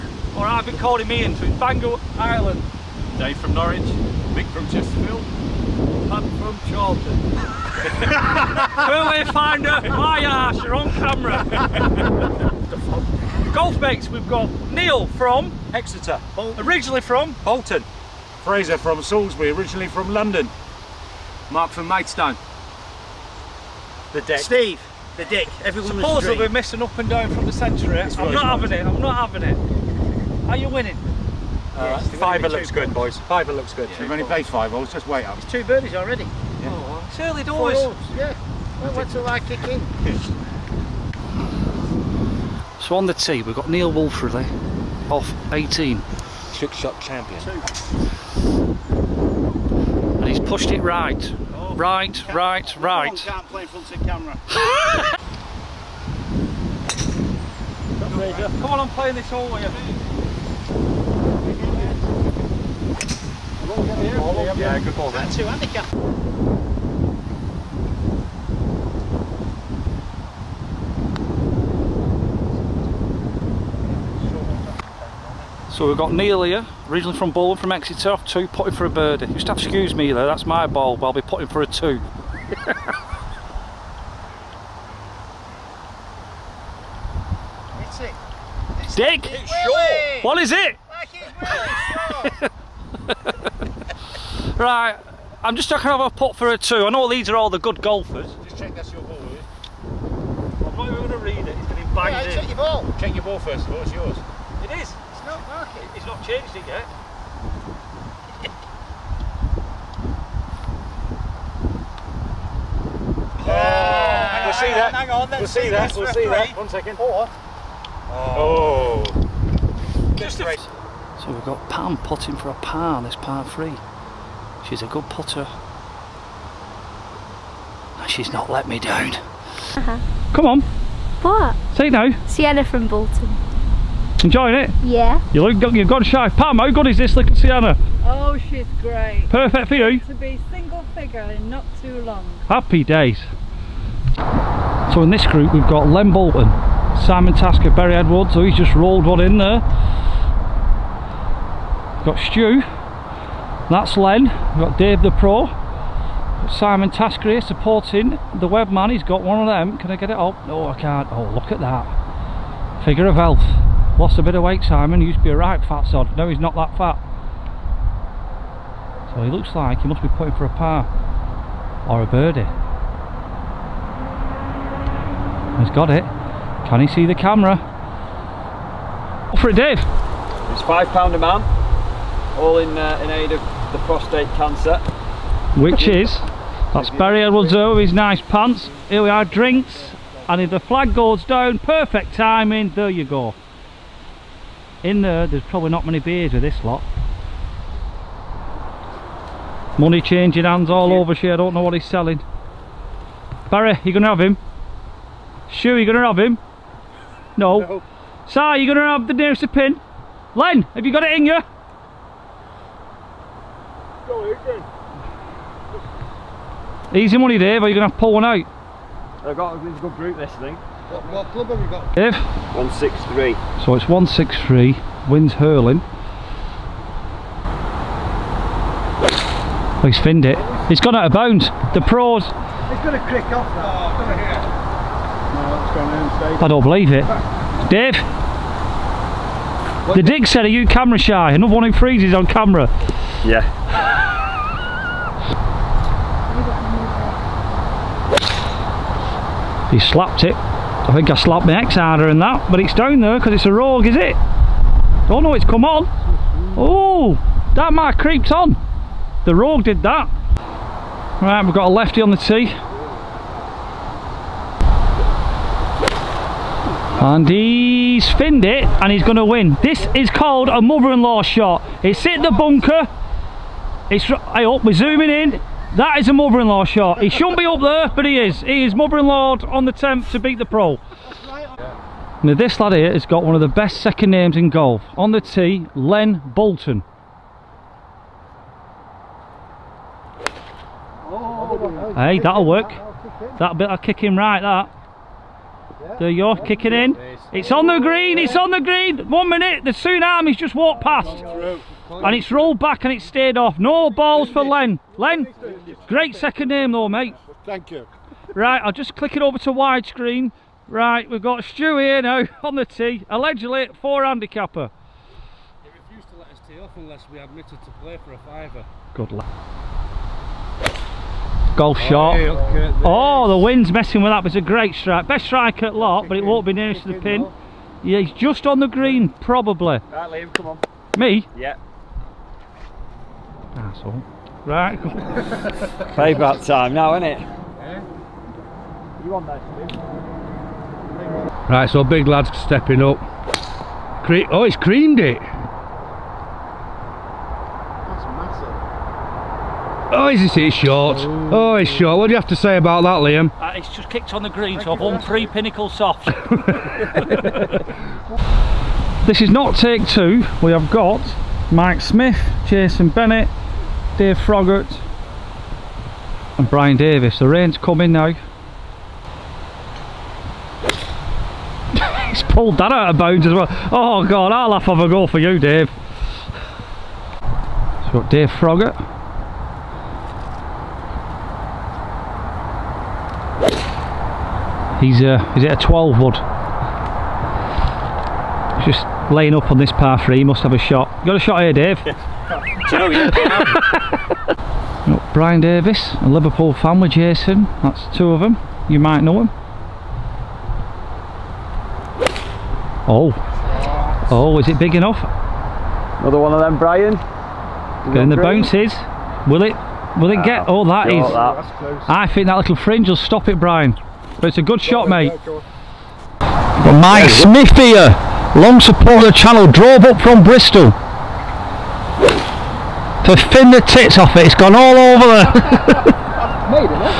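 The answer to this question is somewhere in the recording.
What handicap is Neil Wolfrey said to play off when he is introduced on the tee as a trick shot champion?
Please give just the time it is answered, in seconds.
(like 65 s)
45 s.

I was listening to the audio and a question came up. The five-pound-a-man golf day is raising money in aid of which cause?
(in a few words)
prostate cancer.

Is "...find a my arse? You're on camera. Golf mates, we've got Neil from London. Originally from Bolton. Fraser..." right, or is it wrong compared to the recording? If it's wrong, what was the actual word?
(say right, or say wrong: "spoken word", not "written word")
wrong: "Exeter", not "London".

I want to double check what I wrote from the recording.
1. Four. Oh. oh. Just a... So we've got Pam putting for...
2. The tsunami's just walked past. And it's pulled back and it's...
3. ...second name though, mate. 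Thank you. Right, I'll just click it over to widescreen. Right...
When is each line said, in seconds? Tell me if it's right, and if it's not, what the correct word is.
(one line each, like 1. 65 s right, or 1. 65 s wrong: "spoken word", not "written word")
1. 116 s right
2. 299 s wrong: "rolled", not "pulled"
3. 306 s right.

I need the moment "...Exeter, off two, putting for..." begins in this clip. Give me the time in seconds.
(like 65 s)
77 s.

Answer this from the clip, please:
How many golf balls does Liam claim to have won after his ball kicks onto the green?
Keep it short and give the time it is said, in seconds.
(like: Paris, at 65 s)
3, at 355 s.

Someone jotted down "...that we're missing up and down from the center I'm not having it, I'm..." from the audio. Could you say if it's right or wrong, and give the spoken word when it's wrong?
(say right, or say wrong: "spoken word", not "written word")
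right.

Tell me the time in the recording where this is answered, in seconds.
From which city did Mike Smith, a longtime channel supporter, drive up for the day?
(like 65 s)
420 s.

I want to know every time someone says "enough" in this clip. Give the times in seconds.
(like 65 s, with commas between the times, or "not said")
404 s.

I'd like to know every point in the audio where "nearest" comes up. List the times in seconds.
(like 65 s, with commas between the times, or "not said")
209 s, 326 s.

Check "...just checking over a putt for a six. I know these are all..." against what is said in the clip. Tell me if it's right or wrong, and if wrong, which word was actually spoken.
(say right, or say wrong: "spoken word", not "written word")
wrong: "two", not "six".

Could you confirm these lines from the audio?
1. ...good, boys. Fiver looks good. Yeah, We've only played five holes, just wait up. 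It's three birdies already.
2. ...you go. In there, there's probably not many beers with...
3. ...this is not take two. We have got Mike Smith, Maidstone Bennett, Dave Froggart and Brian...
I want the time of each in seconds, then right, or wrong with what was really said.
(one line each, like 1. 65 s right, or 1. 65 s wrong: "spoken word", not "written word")
1. 32 s wrong: "two", not "three"
2. 192 s right
3. 359 s wrong: "Jason", not "Maidstone".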